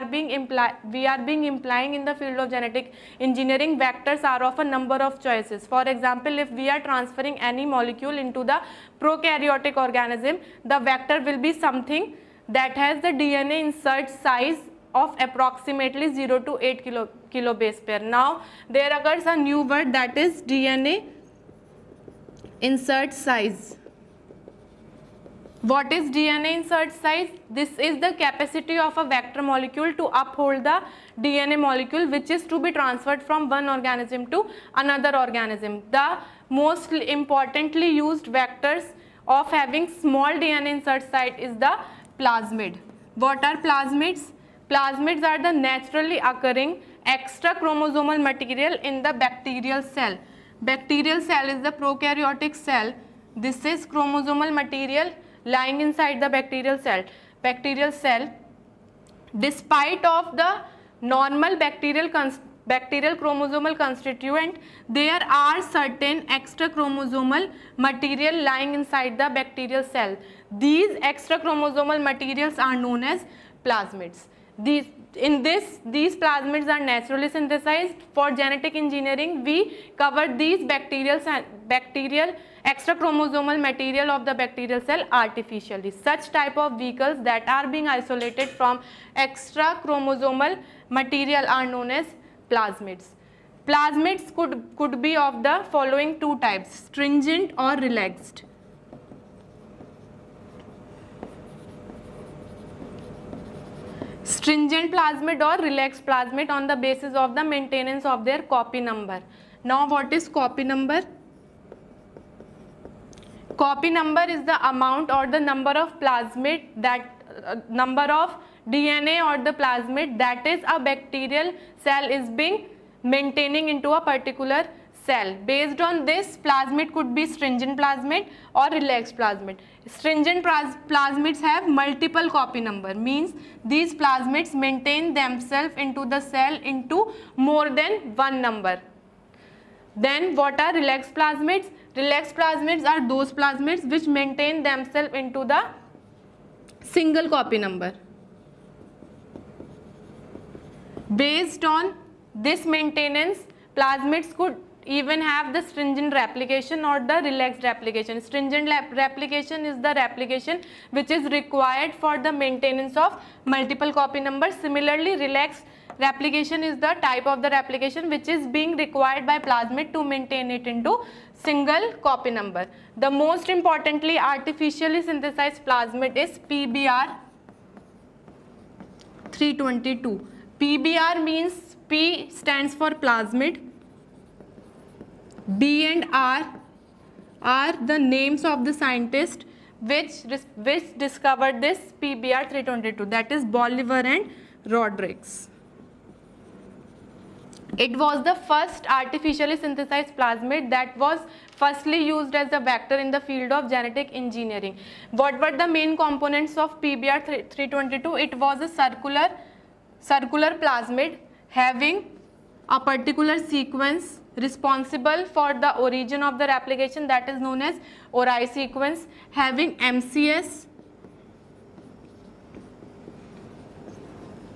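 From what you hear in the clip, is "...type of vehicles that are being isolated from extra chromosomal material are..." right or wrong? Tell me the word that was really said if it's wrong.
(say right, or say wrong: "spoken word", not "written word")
right.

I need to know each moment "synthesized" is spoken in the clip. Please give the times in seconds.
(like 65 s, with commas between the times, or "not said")
77 s, 175 s, 199 s.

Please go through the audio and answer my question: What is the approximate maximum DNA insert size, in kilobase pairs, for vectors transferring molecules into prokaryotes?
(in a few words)
8.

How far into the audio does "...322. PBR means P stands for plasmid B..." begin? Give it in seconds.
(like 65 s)
179 s.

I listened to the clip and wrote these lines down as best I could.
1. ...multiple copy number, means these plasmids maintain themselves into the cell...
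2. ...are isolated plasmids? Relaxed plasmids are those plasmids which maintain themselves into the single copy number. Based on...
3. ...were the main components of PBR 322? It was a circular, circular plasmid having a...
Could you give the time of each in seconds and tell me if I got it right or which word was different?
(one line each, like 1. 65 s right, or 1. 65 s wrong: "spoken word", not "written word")
1. 131 s right
2. 140 s wrong: "relaxed", not "isolated"
3. 205 s right.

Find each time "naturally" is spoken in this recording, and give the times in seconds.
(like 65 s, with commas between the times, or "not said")
45 s, 76 s.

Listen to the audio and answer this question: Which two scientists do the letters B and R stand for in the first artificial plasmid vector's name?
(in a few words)
Bolivar and Rodrigues.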